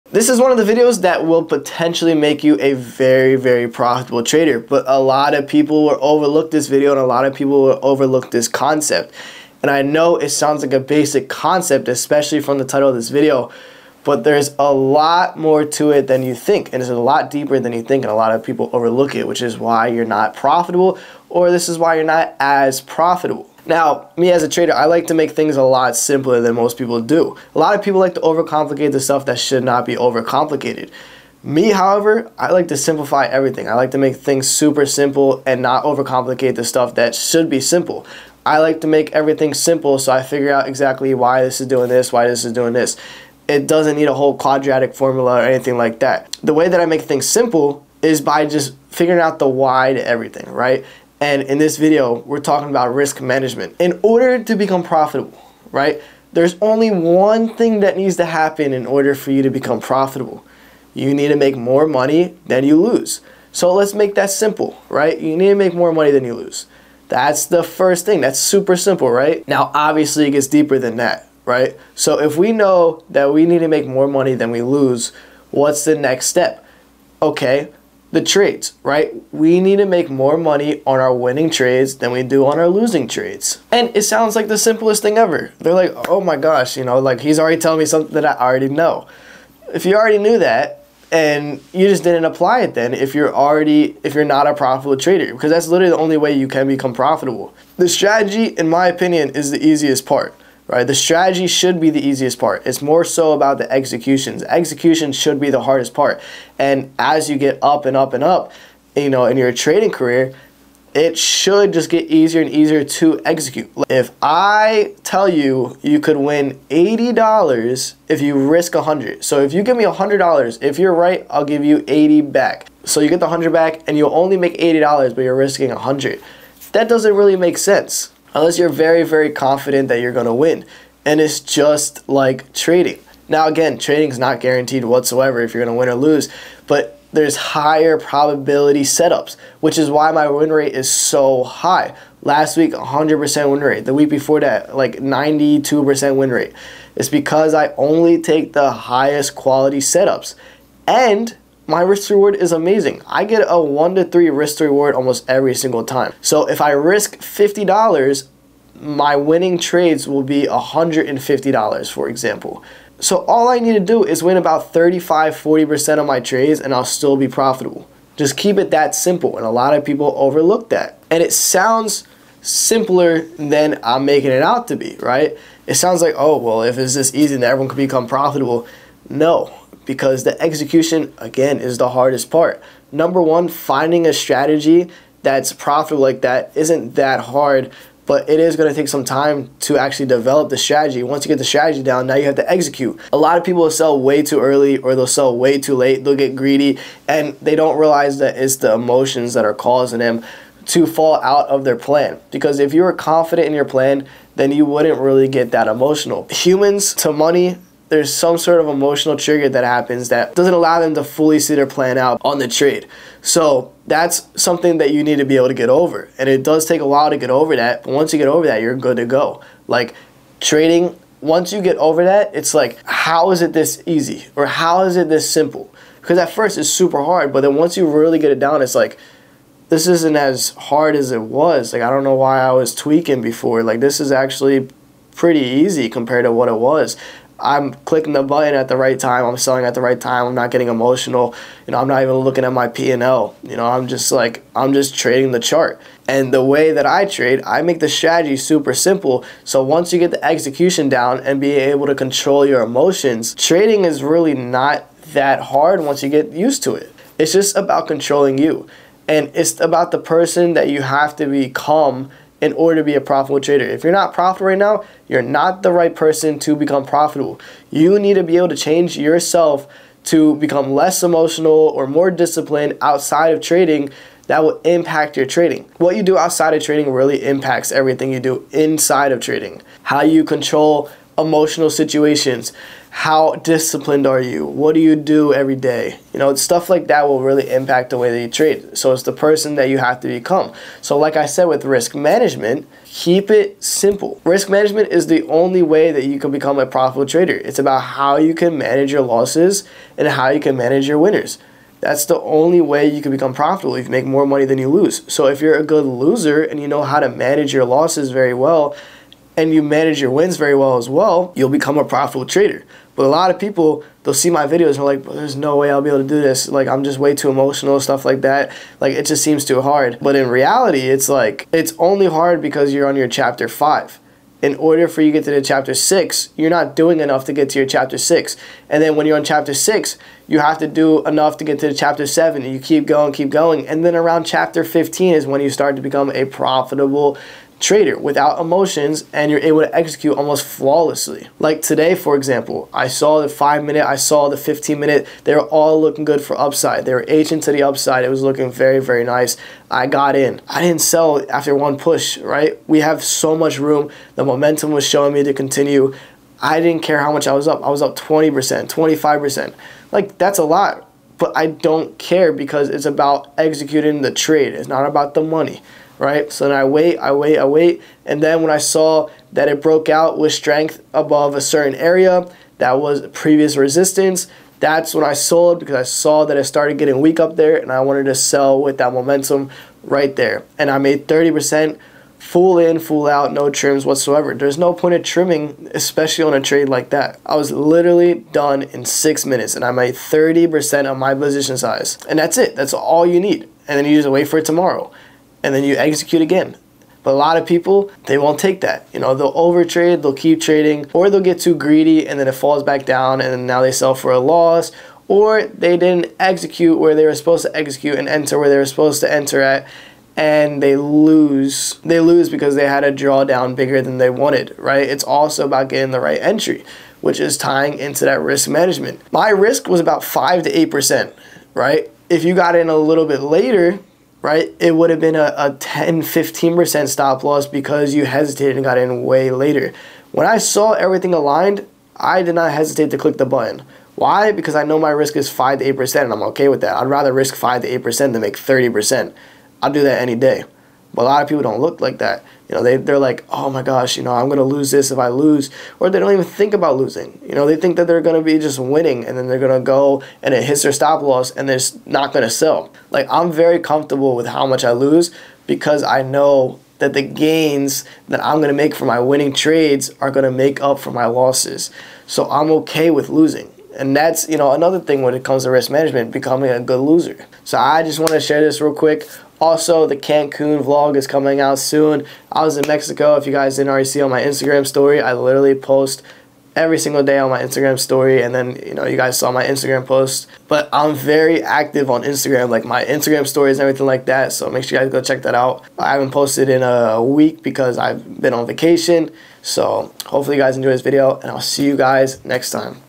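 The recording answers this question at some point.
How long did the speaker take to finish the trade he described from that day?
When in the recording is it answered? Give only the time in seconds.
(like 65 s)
388 s.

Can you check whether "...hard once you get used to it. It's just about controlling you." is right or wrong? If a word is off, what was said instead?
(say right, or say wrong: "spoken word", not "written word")
right.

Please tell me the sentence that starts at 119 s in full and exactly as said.
So if you give me $100, if you're right, I'll give you 80 back.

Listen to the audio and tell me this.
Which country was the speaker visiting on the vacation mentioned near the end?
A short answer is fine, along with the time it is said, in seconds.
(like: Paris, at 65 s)
Mexico, at 472 s.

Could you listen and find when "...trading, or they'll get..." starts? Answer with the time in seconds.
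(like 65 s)
400 s.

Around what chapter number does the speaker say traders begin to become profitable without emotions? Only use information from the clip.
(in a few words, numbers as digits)
15.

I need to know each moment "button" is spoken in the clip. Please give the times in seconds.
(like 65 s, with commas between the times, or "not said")
238 s, 433 s.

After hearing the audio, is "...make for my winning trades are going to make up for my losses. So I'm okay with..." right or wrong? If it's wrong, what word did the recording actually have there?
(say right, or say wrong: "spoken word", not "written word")
right.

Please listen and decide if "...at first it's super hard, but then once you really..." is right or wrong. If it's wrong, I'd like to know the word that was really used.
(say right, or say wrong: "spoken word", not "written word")
right.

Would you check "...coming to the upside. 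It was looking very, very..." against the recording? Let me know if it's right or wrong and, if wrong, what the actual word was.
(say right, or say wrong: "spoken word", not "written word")
wrong: "aging", not "coming".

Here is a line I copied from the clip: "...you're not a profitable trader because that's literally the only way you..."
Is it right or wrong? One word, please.
right.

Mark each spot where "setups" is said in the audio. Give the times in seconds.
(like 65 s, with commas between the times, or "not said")
138 s, 149 s.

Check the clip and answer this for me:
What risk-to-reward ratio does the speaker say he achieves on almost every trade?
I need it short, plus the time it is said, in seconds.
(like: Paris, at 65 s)
1 to 3, at 153 s.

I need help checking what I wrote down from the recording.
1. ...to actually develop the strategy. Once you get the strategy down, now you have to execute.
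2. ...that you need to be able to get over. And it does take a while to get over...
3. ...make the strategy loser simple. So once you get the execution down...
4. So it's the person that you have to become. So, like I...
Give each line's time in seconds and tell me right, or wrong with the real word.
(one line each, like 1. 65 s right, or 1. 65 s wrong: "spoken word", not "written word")
1. 189 s right
2. 214 s right
3. 247 s wrong: "super", not "loser"
4. 288 s right.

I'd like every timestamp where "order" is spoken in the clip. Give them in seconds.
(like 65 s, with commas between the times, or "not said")
54 s, 58 s, 262 s, 324 s.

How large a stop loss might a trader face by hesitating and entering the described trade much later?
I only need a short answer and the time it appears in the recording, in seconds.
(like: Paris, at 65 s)
10 to 15%, at 425 s.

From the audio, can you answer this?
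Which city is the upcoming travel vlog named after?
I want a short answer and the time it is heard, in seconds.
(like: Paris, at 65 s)
Cancun, at 469 s.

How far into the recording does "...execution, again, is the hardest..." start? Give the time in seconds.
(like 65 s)
180 s.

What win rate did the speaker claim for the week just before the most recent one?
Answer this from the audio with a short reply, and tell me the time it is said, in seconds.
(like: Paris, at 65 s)
92%, at 144 s.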